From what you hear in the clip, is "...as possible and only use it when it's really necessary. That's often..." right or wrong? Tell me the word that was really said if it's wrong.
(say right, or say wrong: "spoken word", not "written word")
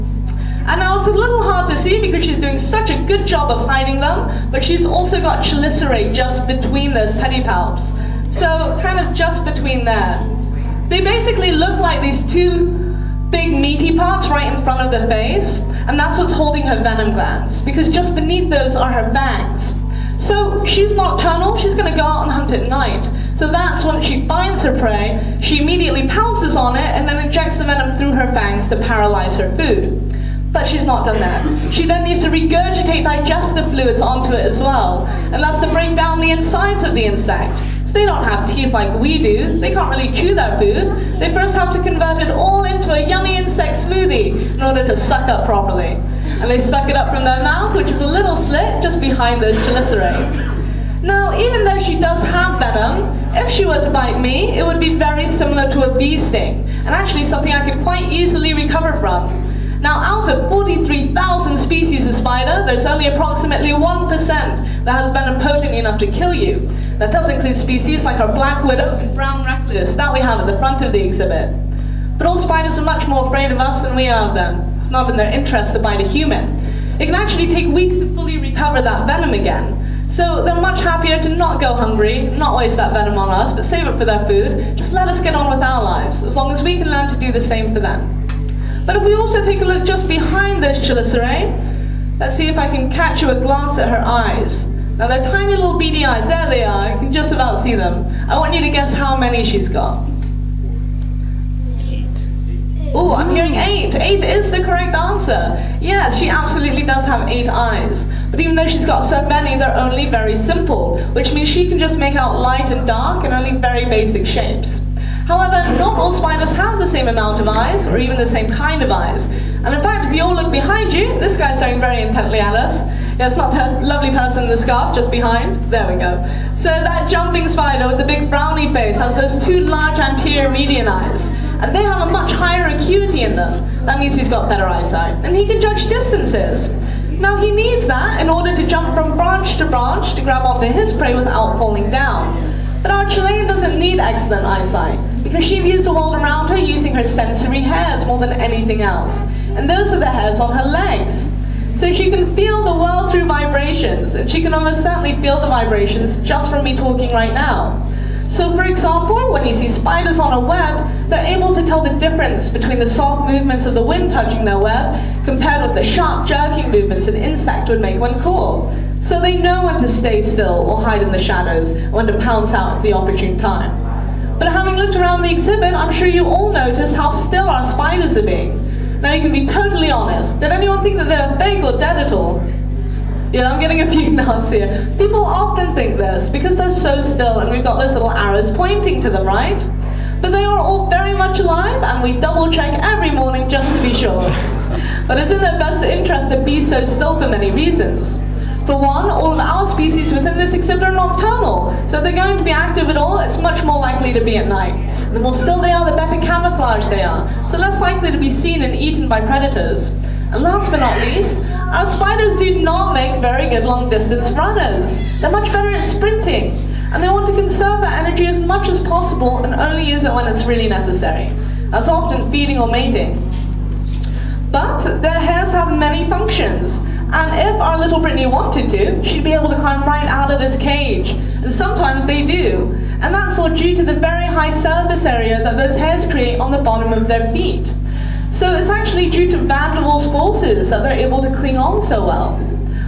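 right.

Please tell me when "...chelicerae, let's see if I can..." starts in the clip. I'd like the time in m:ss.
1:30.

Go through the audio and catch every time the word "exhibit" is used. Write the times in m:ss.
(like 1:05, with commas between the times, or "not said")
1:11, 2:55.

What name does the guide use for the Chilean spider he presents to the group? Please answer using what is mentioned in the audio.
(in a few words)
Britney.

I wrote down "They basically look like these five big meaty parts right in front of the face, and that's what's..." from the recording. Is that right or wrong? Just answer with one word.
wrong.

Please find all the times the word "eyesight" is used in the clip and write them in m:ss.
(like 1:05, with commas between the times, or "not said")
2:14, 2:24.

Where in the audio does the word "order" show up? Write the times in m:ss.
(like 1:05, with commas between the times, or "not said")
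0:44, 2:18.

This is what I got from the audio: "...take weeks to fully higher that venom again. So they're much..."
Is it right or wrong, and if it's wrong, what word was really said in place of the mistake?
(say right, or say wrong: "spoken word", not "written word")
wrong: "recover", not "higher".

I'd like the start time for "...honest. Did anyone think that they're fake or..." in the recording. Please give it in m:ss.
2:59.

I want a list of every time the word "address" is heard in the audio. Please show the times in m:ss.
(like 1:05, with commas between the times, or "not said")
not said.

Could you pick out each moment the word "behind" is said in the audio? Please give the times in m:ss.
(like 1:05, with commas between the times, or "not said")
0:49, 1:30, 2:00, 2:05.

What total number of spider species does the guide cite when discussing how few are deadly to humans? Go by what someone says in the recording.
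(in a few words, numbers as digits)
43,000.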